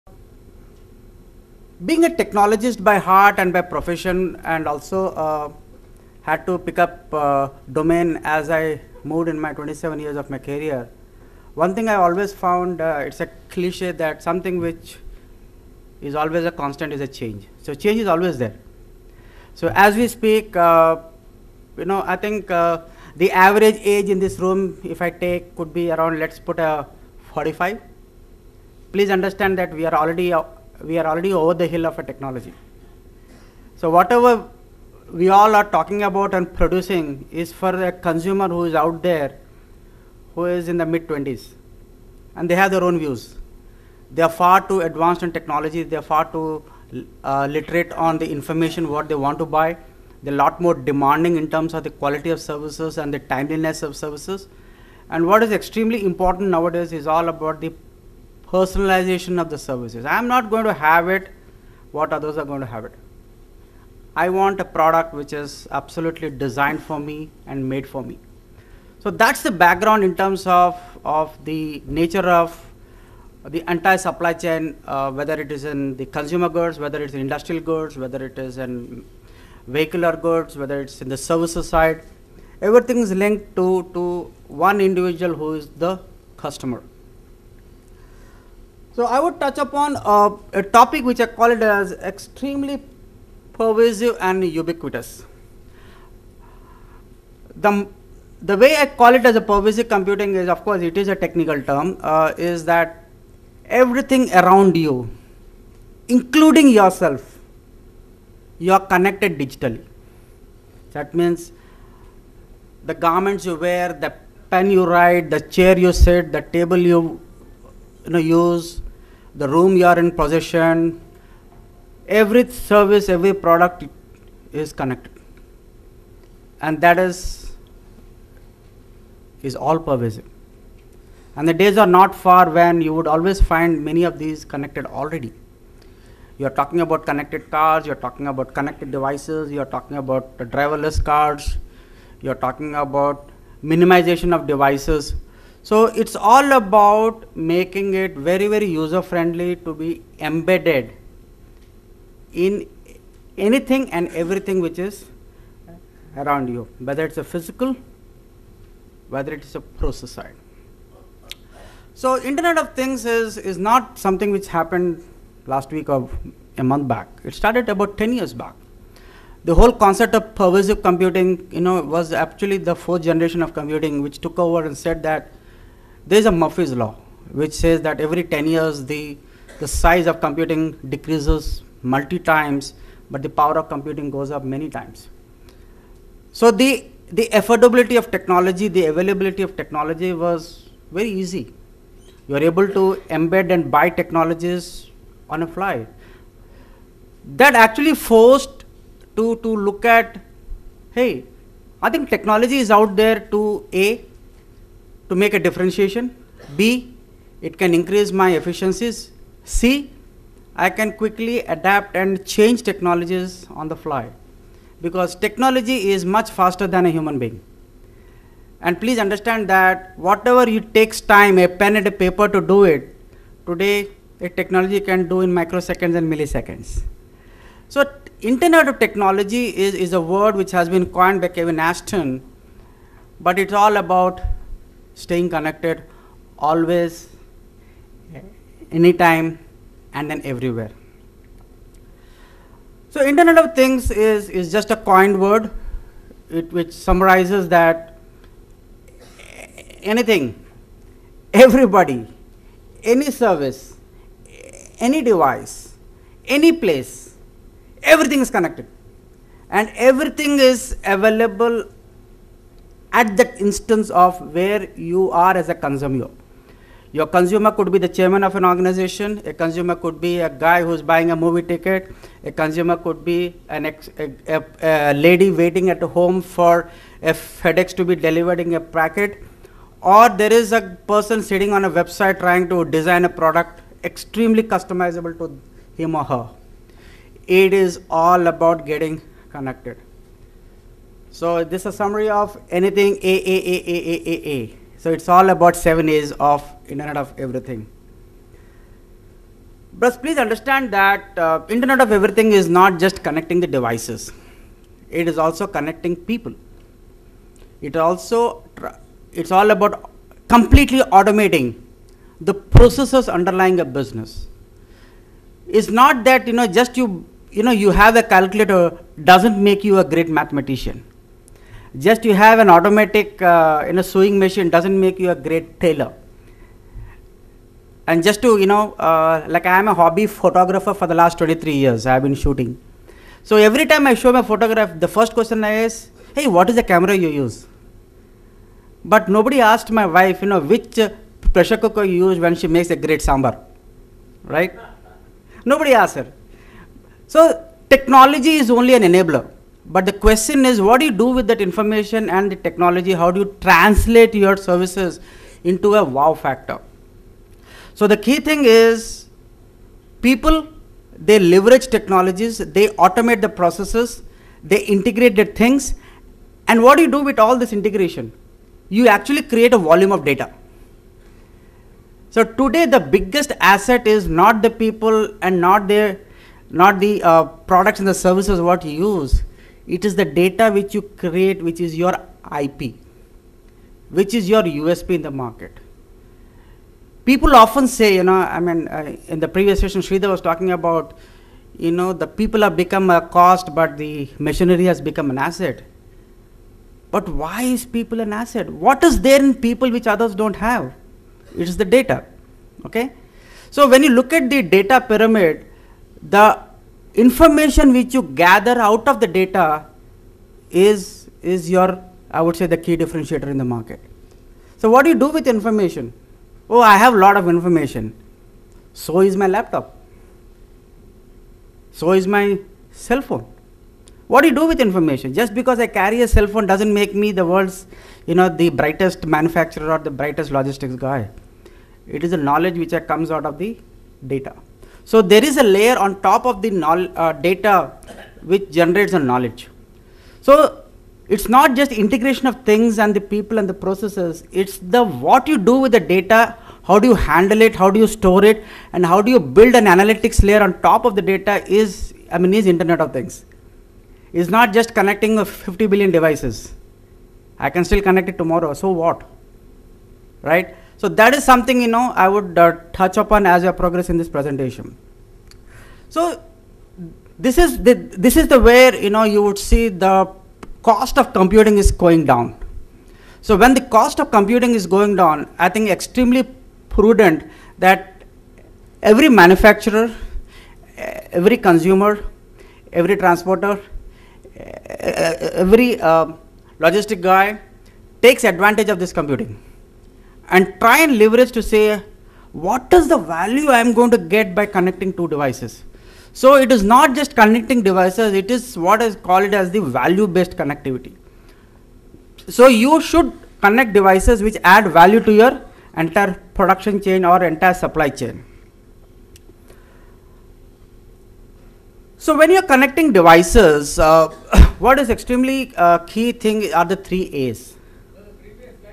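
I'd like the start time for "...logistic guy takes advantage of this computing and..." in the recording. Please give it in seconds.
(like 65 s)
486 s.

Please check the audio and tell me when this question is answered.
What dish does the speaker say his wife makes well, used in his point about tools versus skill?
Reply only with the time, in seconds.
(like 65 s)
343 s.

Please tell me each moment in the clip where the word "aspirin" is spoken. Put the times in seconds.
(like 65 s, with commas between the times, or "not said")
not said.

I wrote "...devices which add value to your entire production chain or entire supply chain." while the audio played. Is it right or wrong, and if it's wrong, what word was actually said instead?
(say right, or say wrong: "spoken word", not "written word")
right.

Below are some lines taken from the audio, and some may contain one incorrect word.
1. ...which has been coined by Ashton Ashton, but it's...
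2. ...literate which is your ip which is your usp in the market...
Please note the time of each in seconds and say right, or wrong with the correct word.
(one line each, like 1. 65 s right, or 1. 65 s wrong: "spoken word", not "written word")
1. 230 s wrong: "Kevin", not "Ashton"
2. 380 s wrong: "create", not "literate".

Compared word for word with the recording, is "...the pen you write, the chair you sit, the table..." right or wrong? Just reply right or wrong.
right.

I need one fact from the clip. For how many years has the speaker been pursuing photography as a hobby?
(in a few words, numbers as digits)
23.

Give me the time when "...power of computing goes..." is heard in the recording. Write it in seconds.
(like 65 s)
183 s.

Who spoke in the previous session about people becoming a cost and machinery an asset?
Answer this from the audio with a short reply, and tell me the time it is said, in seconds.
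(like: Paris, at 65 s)
Sridhar, at 389 s.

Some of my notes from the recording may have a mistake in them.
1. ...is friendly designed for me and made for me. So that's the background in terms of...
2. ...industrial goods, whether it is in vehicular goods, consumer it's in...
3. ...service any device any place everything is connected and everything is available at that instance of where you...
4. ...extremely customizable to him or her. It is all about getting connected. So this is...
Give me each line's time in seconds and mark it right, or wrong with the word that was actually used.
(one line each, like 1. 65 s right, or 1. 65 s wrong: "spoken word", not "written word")
1. 65 s wrong: "absolutely", not "friendly"
2. 77 s wrong: "whether", not "consumer"
3. 253 s right
4. 283 s right.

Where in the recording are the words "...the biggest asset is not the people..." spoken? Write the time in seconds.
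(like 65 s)
372 s.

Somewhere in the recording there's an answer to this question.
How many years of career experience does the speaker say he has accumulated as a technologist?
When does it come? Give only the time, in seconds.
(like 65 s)
9 s.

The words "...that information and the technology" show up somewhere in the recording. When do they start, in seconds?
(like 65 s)
351 s.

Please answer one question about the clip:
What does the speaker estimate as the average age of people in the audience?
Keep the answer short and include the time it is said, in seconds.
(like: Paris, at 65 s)
45, at 27 s.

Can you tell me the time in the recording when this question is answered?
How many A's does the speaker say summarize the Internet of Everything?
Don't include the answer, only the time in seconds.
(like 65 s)
295 s.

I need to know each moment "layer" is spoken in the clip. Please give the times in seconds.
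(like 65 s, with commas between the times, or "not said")
435 s, 450 s.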